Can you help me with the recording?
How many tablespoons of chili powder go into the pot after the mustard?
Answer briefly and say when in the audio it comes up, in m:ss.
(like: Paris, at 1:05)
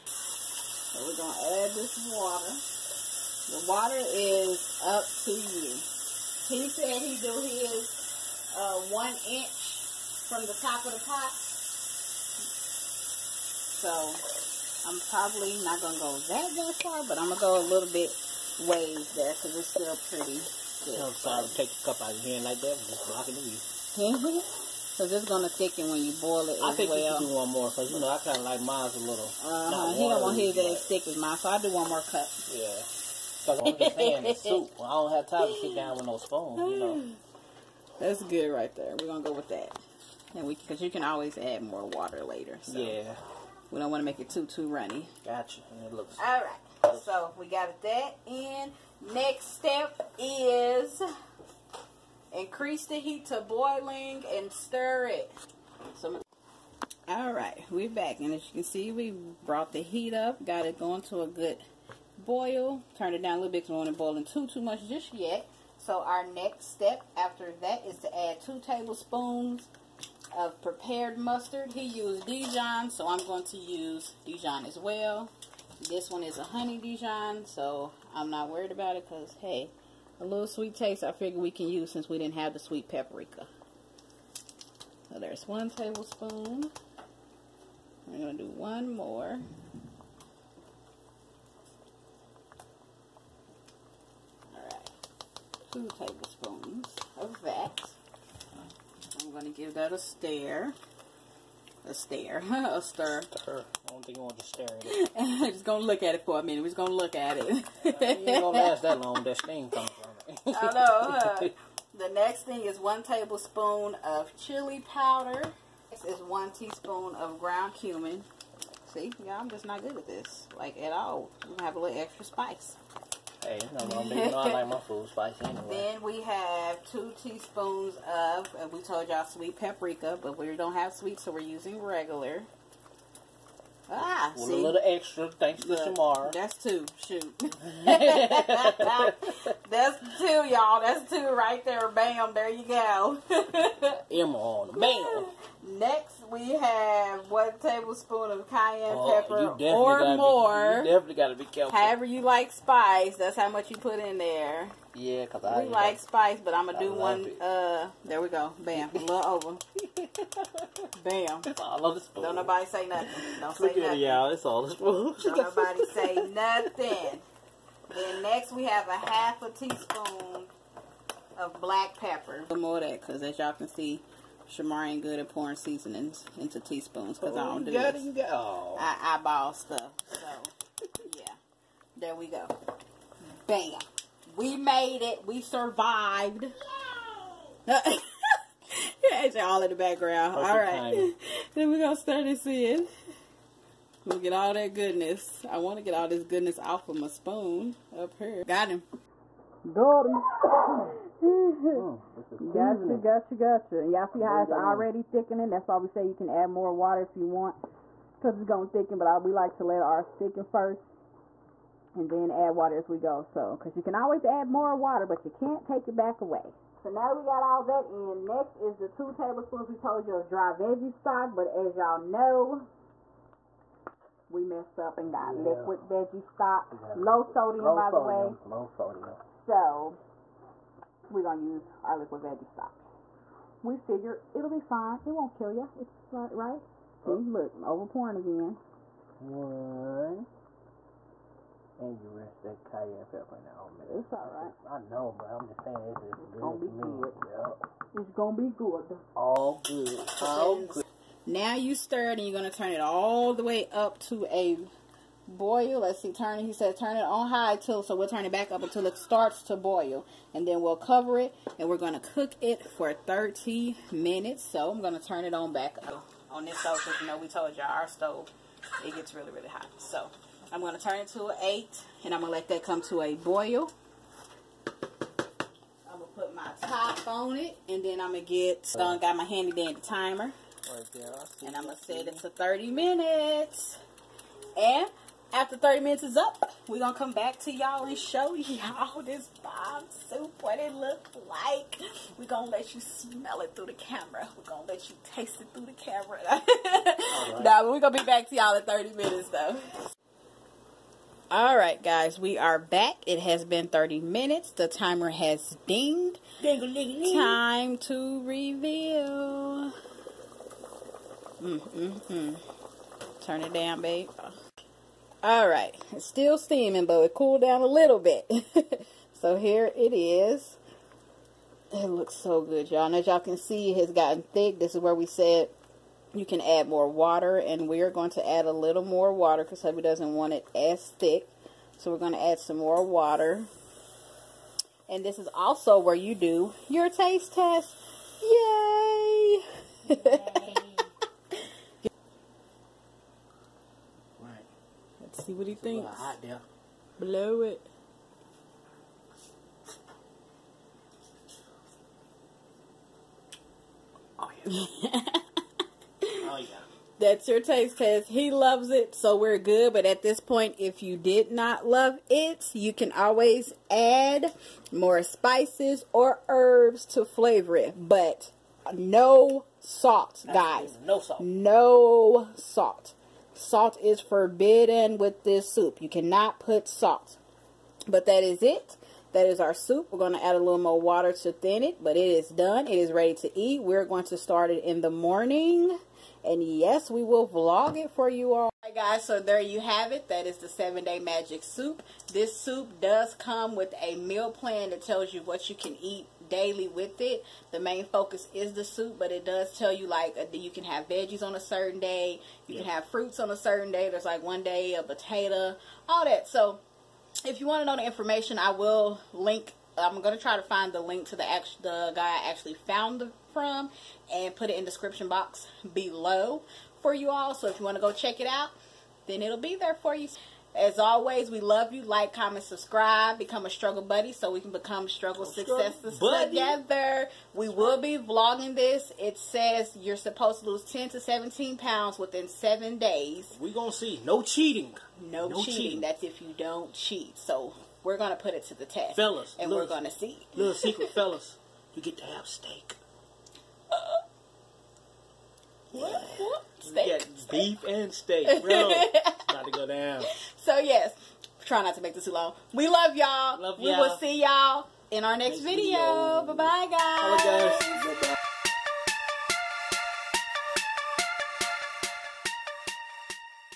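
1, at 1:52.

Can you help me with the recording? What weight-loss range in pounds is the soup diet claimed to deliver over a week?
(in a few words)
10 to 17 pounds.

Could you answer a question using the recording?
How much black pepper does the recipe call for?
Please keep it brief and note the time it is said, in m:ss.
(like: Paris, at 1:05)
Half a teaspoon, at 2:48.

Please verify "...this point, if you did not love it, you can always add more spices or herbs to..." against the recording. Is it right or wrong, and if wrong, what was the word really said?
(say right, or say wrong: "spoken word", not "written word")
right.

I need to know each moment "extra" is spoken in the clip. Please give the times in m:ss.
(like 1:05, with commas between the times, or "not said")
2:01, 2:14.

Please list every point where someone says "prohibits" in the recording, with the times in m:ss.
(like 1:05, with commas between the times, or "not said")
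not said.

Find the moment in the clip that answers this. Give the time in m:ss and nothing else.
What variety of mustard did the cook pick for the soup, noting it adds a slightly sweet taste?
1:16.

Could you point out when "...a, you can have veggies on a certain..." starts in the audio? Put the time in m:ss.
6:40.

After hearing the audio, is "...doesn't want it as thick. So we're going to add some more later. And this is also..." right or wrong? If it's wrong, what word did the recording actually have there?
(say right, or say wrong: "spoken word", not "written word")
wrong: "water", not "later".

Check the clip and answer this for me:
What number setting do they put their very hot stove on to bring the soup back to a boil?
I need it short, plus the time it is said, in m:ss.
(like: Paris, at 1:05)
8, at 4:31.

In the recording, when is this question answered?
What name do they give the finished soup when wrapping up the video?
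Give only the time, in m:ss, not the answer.
6:30.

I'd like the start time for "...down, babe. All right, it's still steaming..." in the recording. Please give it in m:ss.
5:13.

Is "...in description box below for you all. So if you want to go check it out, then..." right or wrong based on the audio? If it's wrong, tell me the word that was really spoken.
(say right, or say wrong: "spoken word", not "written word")
right.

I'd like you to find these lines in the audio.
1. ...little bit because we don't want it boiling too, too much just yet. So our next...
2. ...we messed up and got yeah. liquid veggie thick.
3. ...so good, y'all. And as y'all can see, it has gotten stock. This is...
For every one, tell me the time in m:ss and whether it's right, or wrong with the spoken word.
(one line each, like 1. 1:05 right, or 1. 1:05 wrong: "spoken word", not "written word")
1. 1:03 right
2. 3:44 wrong: "stock", not "thick"
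3. 5:22 wrong: "thick", not "stock".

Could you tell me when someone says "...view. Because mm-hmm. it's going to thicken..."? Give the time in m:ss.
0:23.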